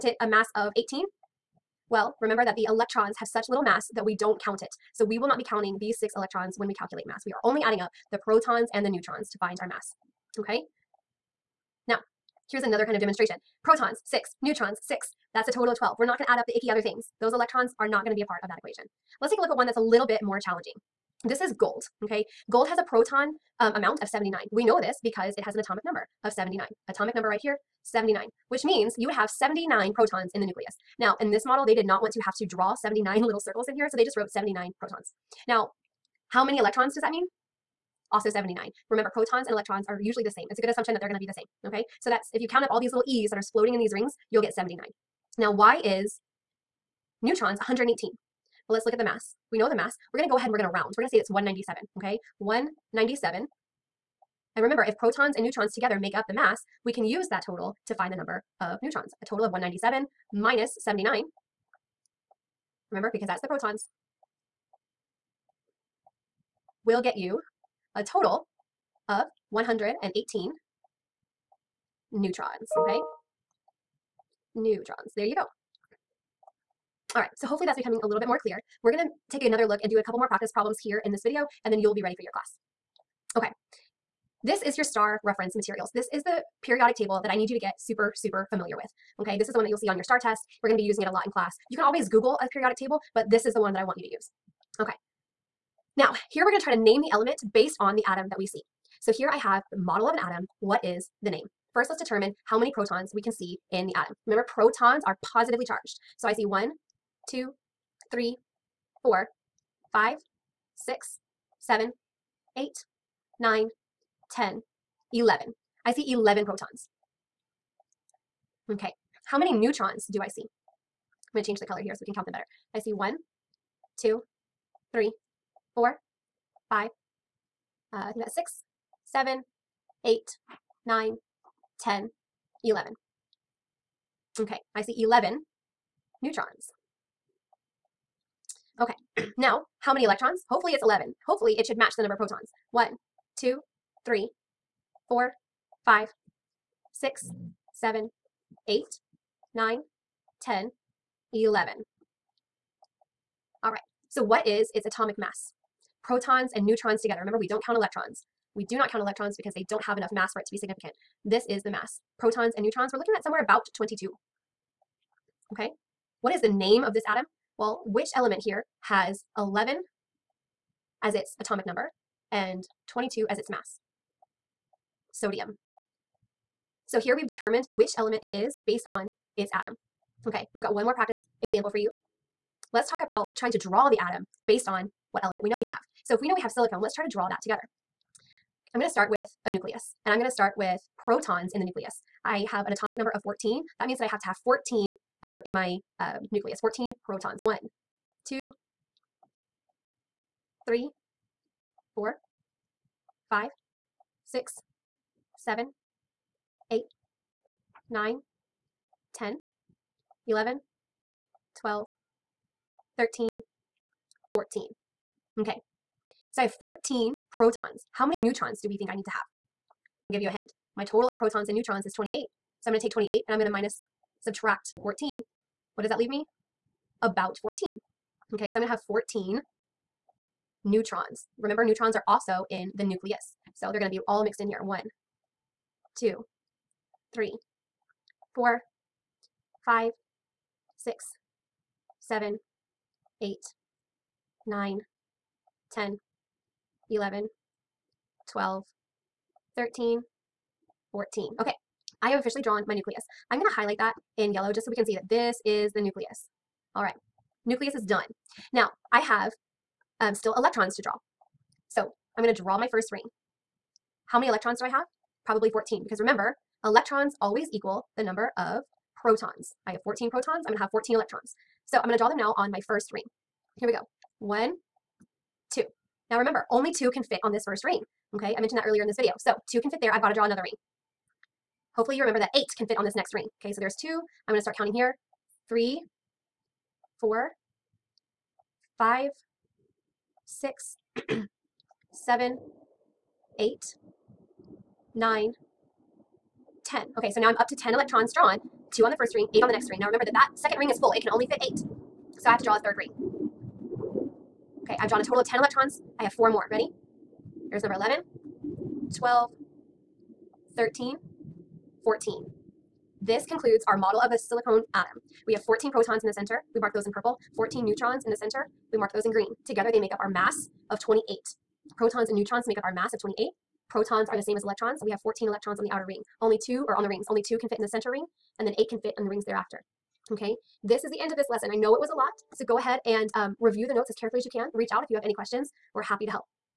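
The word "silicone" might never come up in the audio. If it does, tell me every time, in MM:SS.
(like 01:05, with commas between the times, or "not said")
03:06, 05:14.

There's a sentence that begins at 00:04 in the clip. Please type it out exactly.
So we will not be counting these six electrons when we calculate mass.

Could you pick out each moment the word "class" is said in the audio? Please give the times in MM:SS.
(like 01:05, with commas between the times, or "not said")
01:22, 01:31.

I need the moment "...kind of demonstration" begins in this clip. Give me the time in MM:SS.
00:12.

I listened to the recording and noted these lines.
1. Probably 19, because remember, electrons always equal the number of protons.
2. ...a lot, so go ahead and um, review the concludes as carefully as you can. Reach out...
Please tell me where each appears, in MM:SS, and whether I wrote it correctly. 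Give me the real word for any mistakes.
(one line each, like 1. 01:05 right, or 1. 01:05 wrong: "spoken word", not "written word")
1. 04:25 wrong: "14", not "19"
2. 05:31 wrong: "notes", not "concludes".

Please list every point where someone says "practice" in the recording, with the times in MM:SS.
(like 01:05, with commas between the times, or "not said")
01:20, 03:00.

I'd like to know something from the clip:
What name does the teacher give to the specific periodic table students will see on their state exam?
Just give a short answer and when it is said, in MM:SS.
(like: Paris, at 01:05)
STAR reference materials, at 01:24.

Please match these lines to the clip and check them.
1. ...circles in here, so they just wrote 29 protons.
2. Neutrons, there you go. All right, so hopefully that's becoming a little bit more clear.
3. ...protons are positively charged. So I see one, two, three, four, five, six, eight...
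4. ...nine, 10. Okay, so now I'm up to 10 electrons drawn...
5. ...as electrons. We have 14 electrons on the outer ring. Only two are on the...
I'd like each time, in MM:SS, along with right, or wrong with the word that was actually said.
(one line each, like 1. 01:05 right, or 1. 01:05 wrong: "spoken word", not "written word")
1. 00:33 wrong: "79", not "29"
2. 01:14 right
3. 01:44 wrong: "seven", not "eight"
4. 04:54 right
5. 05:24 right.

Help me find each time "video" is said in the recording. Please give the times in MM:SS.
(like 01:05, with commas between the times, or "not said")
01:21, 04:38.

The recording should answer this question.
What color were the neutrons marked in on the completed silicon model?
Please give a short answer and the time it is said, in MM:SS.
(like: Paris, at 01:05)
Green, at 05:19.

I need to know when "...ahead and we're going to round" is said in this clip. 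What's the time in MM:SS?
00:50.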